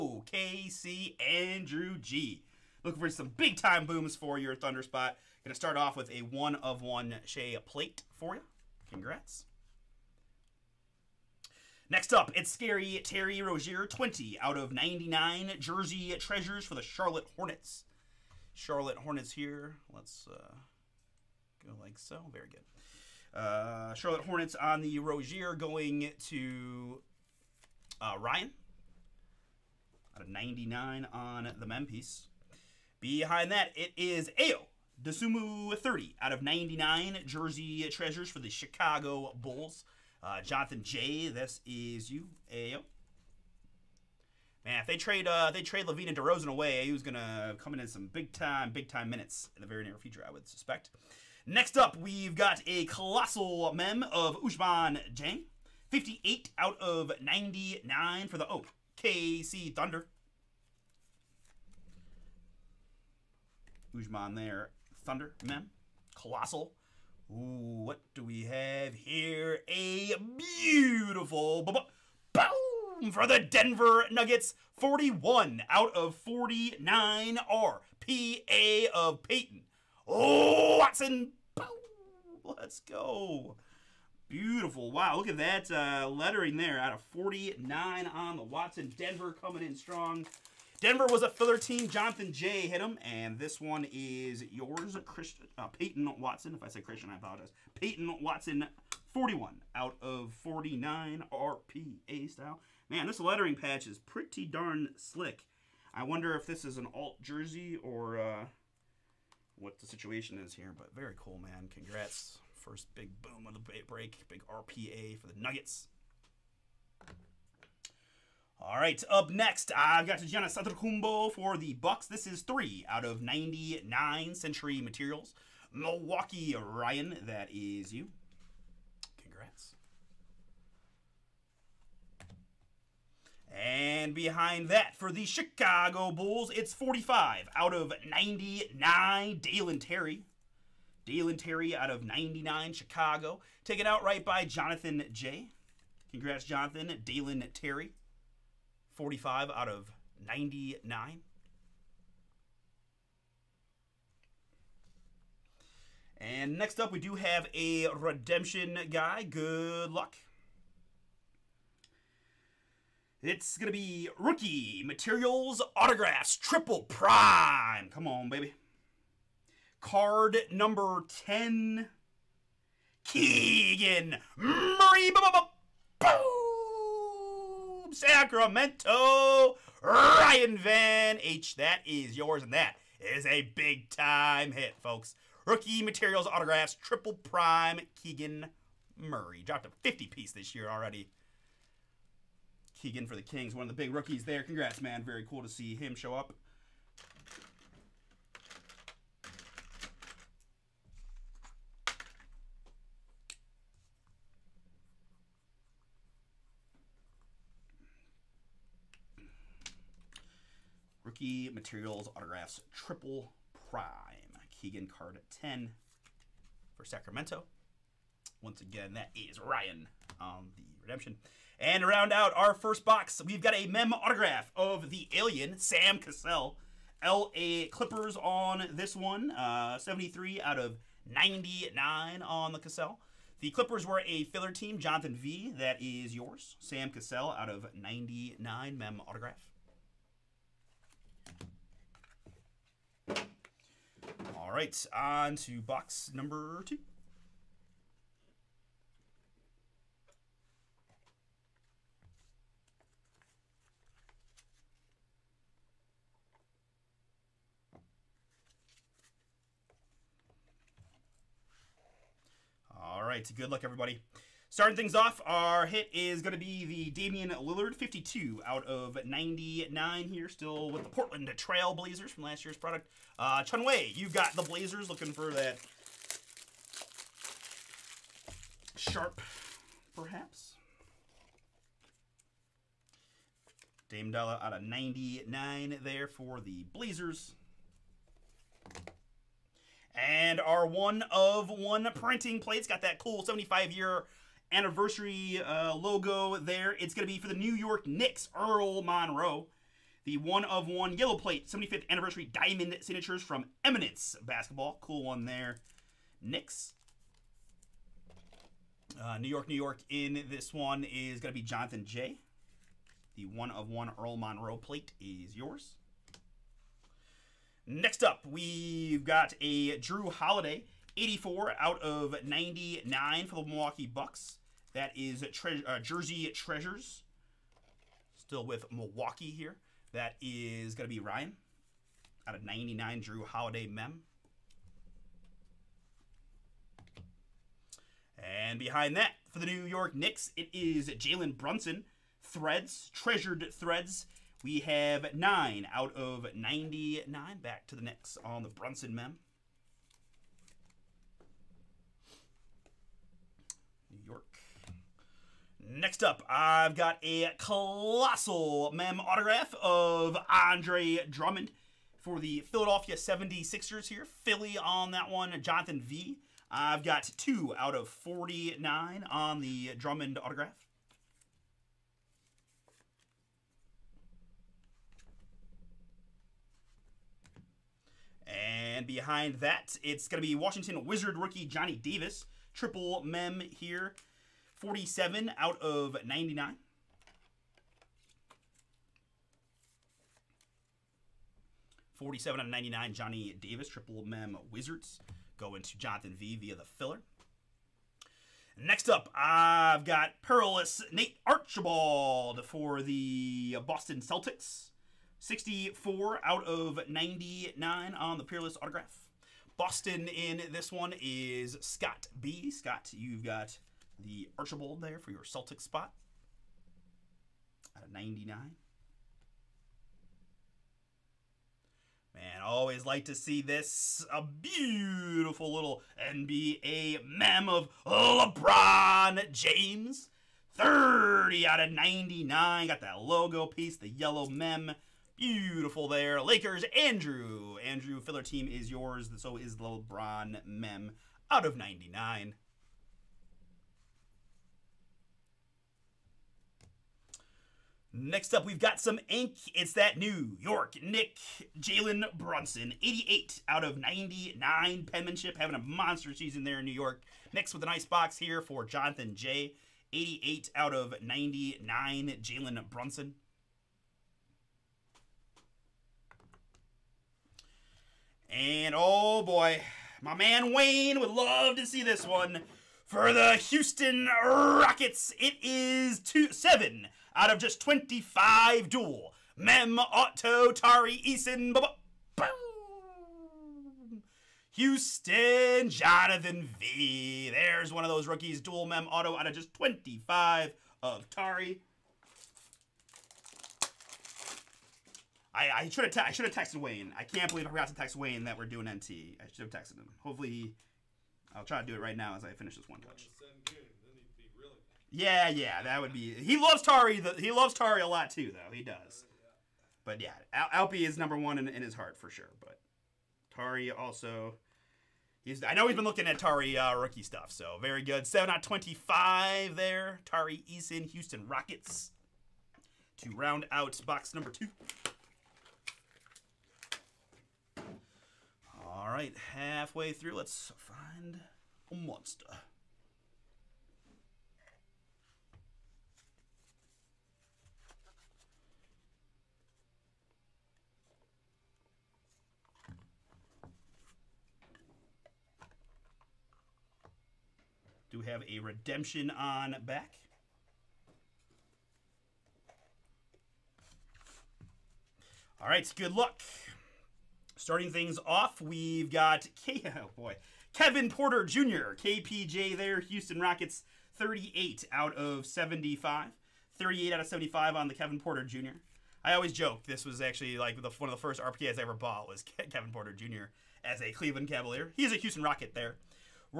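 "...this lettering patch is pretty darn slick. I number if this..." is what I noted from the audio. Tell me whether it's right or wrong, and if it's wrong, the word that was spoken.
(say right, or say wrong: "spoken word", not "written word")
wrong: "wonder", not "number".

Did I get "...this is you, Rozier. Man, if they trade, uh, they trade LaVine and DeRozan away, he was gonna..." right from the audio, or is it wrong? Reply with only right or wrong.
wrong.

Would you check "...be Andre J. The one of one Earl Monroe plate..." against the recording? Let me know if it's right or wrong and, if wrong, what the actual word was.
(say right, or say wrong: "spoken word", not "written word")
wrong: "Jonathan", not "Andre".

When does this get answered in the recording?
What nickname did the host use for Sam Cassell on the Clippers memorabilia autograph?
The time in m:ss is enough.
3:44.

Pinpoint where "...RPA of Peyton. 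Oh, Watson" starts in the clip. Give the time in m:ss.
1:17.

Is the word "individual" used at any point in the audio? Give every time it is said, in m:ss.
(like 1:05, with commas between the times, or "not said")
not said.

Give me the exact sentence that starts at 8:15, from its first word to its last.
I, I should have I should have texted Wayne.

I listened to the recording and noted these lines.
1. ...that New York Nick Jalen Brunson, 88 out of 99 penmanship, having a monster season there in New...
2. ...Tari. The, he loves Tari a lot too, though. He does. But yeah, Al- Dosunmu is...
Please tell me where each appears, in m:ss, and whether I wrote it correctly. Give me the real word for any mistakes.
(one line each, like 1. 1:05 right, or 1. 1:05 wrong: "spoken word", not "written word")
1. 7:29 right
2. 8:26 wrong: "Alpi", not "Dosunmu".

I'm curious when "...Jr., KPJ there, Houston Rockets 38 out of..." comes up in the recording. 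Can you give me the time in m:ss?
9:21.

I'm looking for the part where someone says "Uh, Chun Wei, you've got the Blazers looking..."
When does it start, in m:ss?
4:33.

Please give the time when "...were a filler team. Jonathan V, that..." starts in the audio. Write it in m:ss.
3:53.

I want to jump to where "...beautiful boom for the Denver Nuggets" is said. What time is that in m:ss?
1:10.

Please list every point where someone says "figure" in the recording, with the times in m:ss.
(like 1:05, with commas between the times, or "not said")
not said.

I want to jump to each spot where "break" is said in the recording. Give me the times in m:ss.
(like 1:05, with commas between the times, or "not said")
1:53.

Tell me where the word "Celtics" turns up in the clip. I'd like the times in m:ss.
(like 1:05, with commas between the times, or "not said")
6:44, 6:55.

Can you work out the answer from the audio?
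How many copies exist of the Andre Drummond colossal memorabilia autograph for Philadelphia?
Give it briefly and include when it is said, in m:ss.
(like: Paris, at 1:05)
49, at 6:07.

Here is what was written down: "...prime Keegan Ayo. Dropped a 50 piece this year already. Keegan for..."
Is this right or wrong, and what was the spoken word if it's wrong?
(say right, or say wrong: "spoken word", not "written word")
wrong: "Murray", not "Ayo".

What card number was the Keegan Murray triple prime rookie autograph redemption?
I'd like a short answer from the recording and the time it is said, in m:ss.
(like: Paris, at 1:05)
10, at 2:49.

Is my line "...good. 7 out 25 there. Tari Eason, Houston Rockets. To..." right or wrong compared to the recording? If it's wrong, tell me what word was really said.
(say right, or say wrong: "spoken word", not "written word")
right.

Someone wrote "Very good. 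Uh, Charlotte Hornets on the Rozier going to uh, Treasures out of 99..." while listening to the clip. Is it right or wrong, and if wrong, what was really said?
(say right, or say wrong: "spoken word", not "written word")
wrong: "Ryan", not "Treasures".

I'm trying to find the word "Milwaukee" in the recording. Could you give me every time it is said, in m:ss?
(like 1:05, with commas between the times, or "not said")
2:05, 5:23, 5:28.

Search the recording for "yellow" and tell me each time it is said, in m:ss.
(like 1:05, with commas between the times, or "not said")
5:00, 7:13.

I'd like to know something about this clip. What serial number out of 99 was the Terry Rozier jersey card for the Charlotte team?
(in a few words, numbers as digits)
20.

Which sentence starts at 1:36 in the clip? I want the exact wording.
If I say Christian, I apologize.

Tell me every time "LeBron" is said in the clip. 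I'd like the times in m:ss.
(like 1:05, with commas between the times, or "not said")
7:07, 7:19.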